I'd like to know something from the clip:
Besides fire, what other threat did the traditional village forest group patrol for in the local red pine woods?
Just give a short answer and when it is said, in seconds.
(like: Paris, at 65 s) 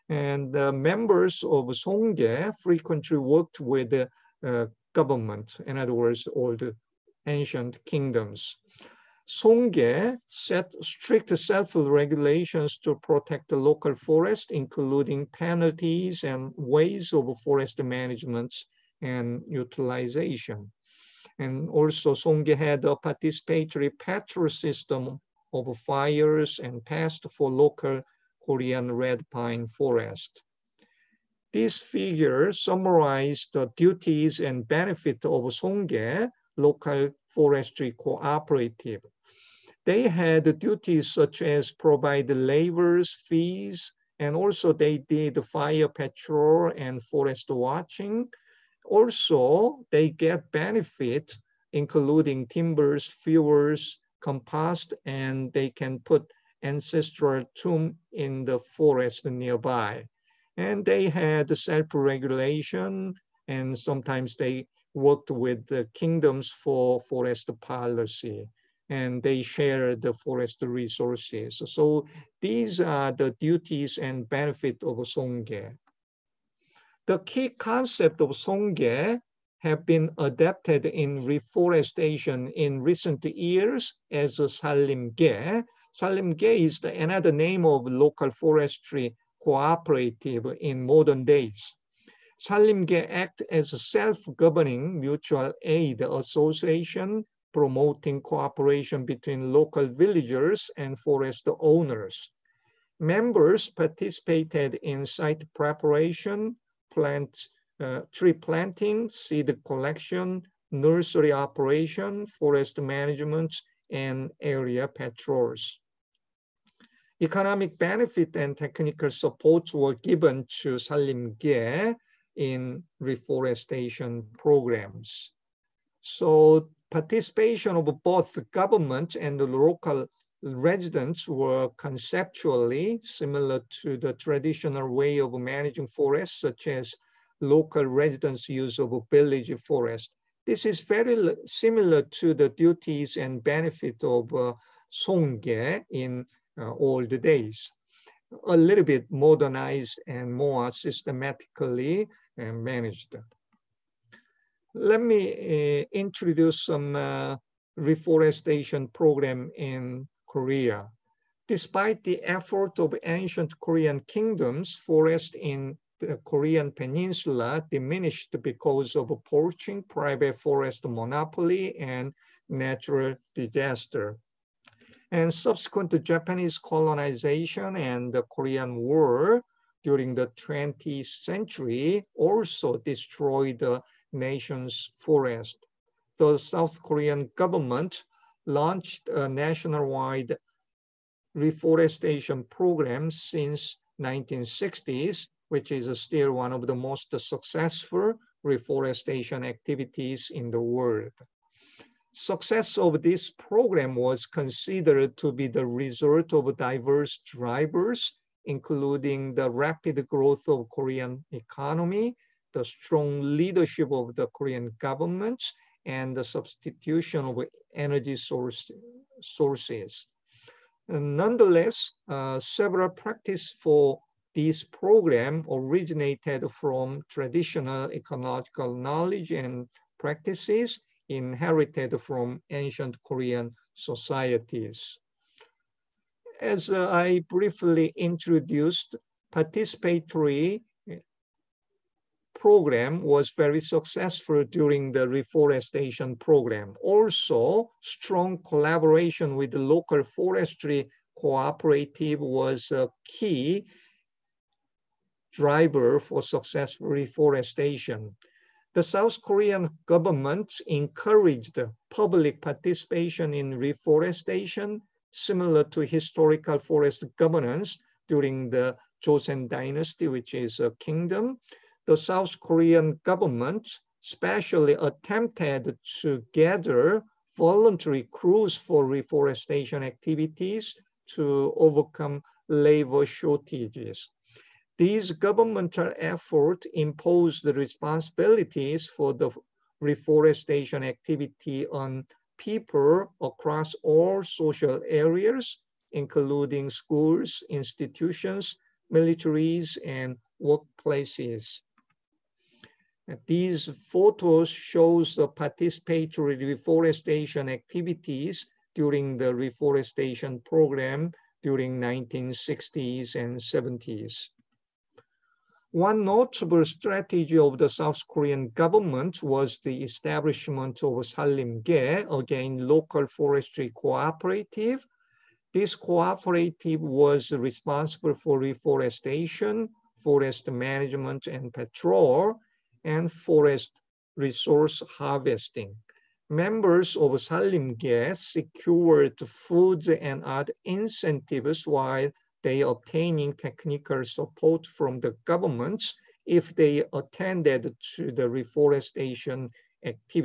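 Pests, at 26 s.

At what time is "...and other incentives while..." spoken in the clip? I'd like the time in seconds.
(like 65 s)
340 s.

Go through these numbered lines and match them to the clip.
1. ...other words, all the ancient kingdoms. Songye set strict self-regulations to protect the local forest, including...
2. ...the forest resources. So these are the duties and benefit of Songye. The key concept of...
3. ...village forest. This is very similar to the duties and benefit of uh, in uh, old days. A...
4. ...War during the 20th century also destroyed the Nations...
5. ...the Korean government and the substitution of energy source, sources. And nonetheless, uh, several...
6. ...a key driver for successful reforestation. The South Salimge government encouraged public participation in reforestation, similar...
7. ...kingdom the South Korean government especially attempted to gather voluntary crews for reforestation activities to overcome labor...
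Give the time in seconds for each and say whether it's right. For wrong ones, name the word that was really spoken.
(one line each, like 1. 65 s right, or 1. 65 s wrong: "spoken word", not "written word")
1. 5 s right
2. 69 s right
3. 139 s right
4. 178 s right
5. 214 s right
6. 252 s wrong: "Korean", not "Salimge"
7. 270 s right.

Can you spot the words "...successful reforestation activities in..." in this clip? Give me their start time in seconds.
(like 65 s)
197 s.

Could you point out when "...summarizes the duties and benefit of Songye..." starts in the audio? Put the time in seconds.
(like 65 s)
32 s.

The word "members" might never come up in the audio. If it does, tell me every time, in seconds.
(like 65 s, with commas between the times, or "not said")
0 s, 102 s, 336 s.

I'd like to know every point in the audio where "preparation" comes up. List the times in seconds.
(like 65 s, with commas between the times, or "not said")
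105 s.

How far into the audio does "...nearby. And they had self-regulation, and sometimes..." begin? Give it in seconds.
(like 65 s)
59 s.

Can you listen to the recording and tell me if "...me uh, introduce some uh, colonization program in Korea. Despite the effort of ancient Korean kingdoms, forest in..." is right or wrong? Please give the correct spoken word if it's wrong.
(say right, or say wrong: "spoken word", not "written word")
wrong: "reforestation", not "colonization".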